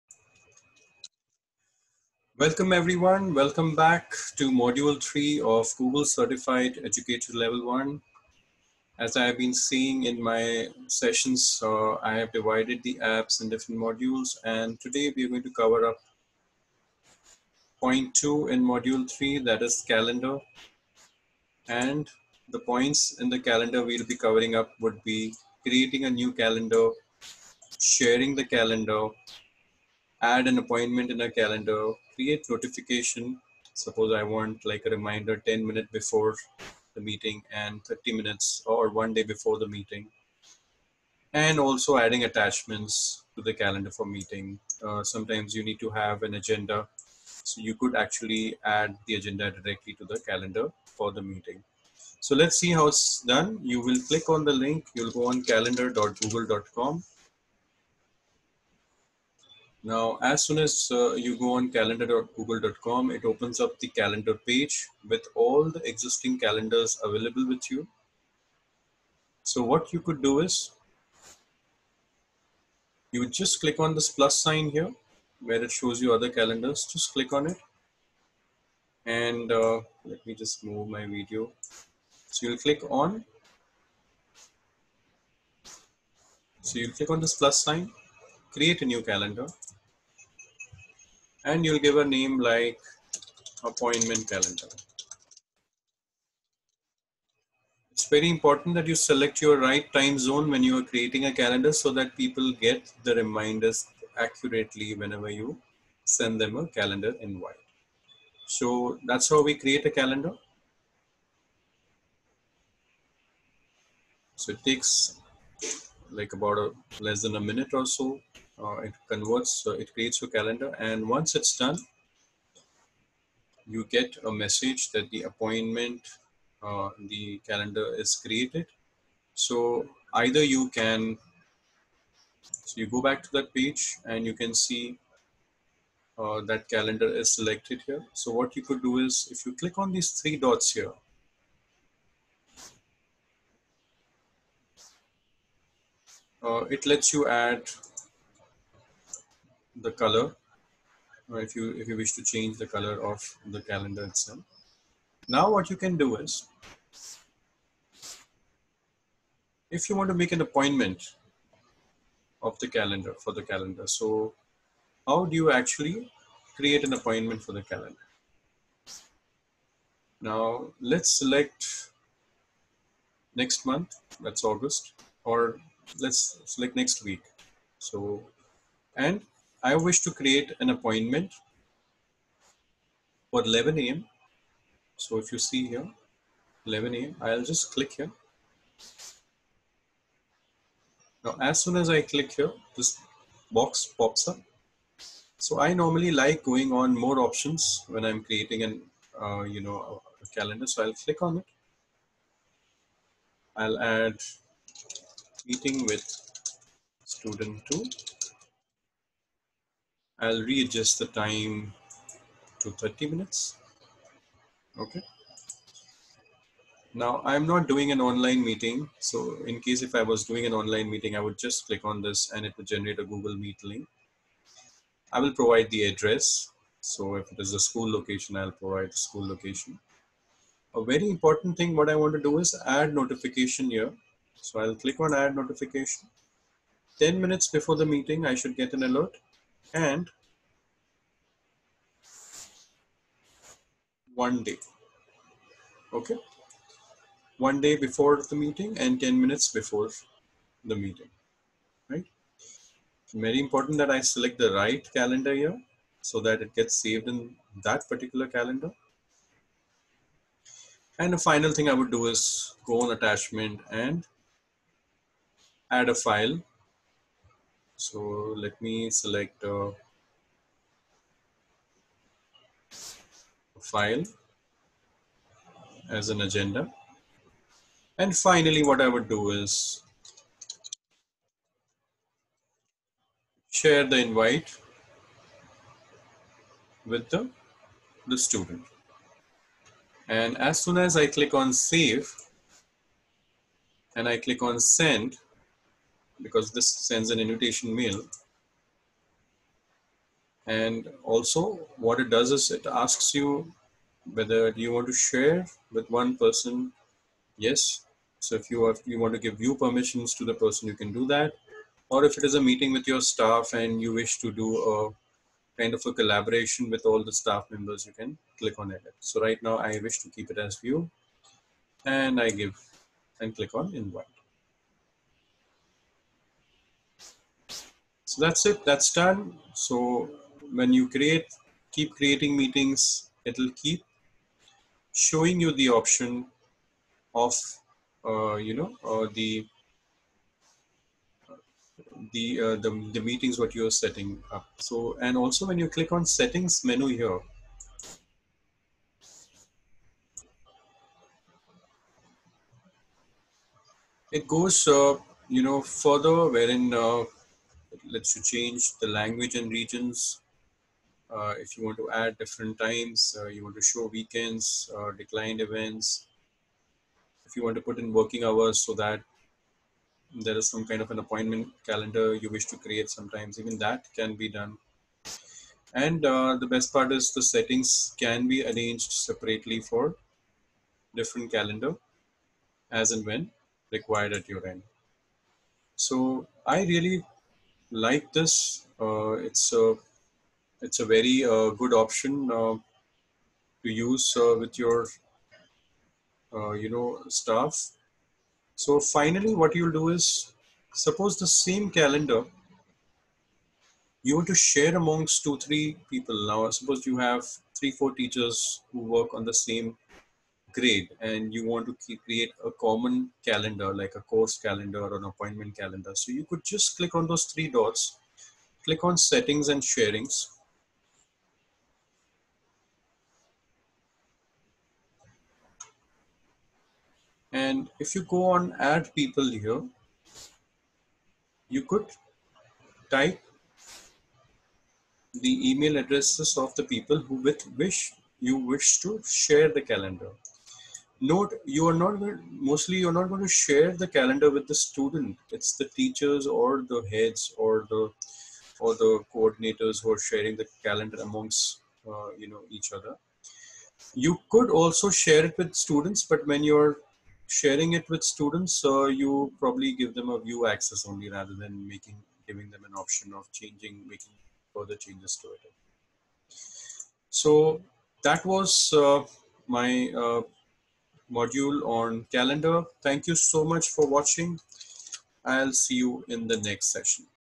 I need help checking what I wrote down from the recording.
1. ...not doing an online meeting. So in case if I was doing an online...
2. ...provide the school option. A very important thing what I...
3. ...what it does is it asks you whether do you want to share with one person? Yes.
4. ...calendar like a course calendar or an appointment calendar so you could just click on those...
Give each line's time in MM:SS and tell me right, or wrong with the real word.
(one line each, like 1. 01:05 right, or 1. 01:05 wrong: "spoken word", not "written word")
1. 03:37 right
2. 03:48 wrong: "location", not "option"
3. 05:01 right
4. 06:53 right.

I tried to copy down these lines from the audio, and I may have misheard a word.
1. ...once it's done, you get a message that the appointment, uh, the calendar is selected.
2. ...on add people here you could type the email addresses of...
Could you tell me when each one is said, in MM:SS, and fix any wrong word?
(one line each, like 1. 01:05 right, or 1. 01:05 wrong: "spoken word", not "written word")
1. 02:01 wrong: "created", not "selected"
2. 07:08 right.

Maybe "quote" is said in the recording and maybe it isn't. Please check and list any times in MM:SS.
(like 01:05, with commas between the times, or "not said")
not said.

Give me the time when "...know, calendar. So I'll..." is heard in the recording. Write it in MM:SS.
03:19.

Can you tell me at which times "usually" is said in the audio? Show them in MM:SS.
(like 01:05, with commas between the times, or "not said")
not said.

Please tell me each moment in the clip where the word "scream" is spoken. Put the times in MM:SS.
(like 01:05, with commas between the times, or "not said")
not said.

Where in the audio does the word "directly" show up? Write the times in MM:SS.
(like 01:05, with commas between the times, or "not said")
00:49.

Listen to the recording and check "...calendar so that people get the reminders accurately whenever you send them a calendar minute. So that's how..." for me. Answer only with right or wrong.
wrong.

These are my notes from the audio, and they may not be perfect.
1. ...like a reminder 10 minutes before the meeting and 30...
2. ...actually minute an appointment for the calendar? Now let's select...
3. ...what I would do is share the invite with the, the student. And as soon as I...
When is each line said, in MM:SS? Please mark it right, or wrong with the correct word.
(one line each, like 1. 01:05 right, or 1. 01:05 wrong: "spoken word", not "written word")
1. 00:34 right
2. 02:45 wrong: "create", not "minute"
3. 04:38 right.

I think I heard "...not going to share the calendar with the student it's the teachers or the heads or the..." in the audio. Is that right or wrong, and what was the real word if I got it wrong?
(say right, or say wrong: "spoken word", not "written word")
right.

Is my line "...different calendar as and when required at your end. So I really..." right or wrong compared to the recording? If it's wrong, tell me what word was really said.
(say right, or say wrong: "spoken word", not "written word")
right.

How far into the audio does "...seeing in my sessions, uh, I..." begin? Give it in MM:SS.
00:09.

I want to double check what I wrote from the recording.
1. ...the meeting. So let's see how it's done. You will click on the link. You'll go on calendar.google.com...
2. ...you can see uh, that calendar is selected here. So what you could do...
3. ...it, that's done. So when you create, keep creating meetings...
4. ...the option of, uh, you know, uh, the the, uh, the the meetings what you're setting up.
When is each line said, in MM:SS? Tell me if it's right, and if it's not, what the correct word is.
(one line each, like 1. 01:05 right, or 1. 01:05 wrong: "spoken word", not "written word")
1. 00:51 right
2. 02:14 right
3. 05:28 right
4. 05:35 right.